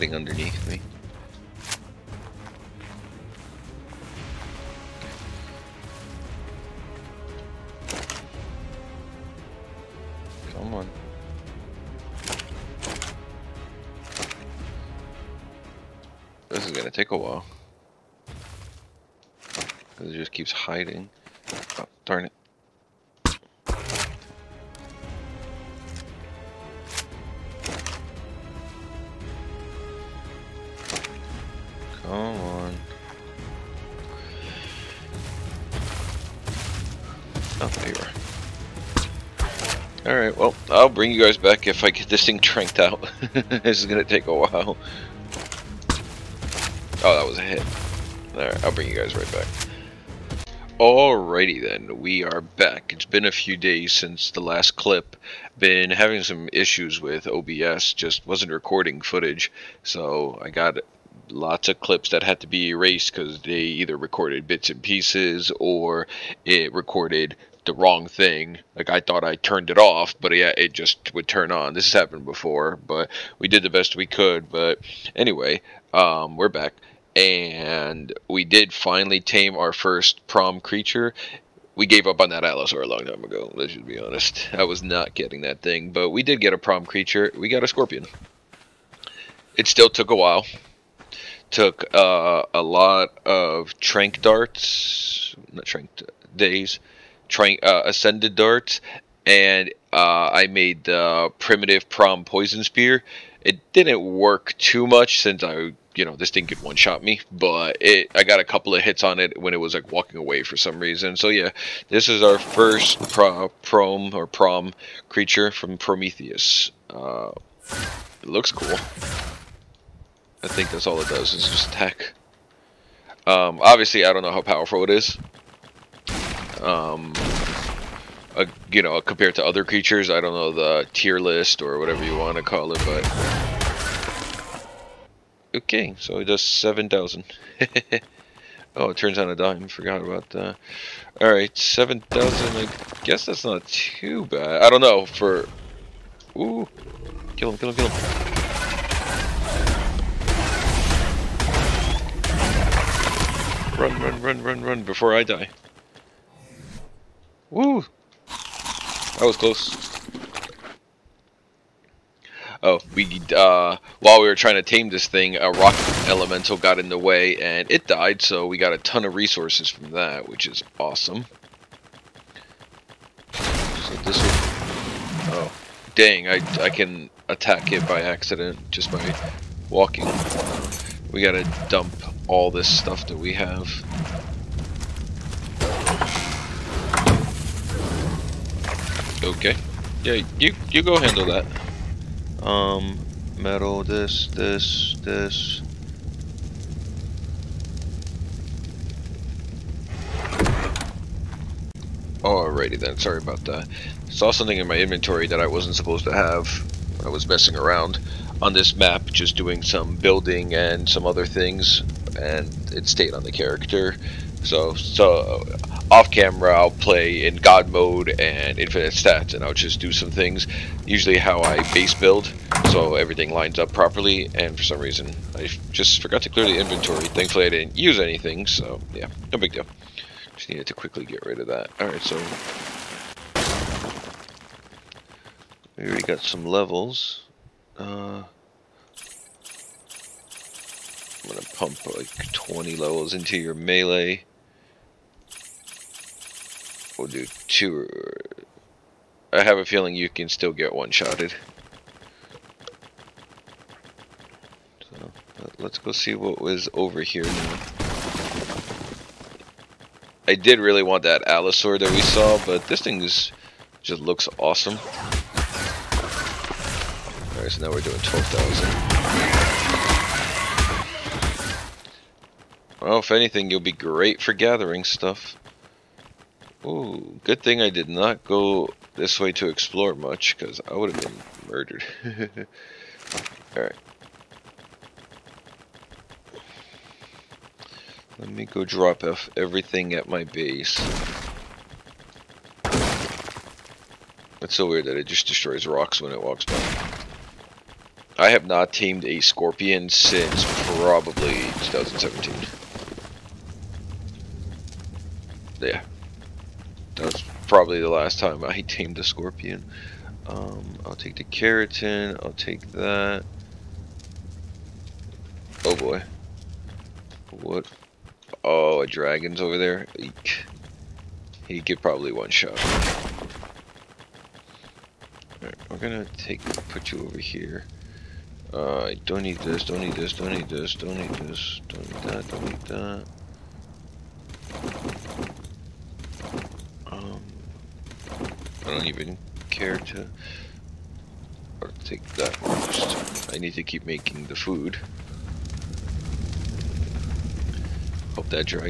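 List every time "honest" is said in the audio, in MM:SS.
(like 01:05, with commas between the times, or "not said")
01:23.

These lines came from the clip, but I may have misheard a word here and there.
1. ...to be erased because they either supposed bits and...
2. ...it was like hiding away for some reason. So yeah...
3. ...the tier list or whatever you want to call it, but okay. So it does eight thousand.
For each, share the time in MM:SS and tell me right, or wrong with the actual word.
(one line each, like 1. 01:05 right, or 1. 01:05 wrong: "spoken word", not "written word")
1. 01:02 wrong: "recorded", not "supposed"
2. 01:49 wrong: "walking", not "hiding"
3. 02:10 wrong: "seven", not "eight".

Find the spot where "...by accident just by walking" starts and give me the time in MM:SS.
02:57.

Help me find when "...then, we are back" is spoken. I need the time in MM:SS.
00:51.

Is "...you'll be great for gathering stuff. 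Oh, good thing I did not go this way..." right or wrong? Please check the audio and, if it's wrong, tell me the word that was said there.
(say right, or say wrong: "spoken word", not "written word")
right.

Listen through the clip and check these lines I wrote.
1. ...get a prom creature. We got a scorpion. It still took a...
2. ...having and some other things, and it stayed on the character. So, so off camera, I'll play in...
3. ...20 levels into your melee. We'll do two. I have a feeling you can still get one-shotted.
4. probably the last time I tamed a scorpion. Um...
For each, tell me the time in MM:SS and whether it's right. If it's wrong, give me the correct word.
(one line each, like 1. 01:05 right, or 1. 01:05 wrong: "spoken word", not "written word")
1. 01:26 right
2. 03:29 wrong: "building", not "having"
3. 04:02 right
4. 05:07 right.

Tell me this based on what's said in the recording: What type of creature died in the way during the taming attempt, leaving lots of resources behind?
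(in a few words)
Rock elemental.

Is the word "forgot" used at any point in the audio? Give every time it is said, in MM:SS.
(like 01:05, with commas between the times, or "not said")
02:19, 03:46.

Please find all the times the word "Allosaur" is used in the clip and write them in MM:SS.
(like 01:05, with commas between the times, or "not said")
01:22, 04:21.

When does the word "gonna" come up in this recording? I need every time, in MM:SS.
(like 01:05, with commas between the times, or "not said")
04:01, 05:25.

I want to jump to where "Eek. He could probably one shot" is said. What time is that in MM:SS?
05:19.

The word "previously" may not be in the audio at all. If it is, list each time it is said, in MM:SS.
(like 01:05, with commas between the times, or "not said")
not said.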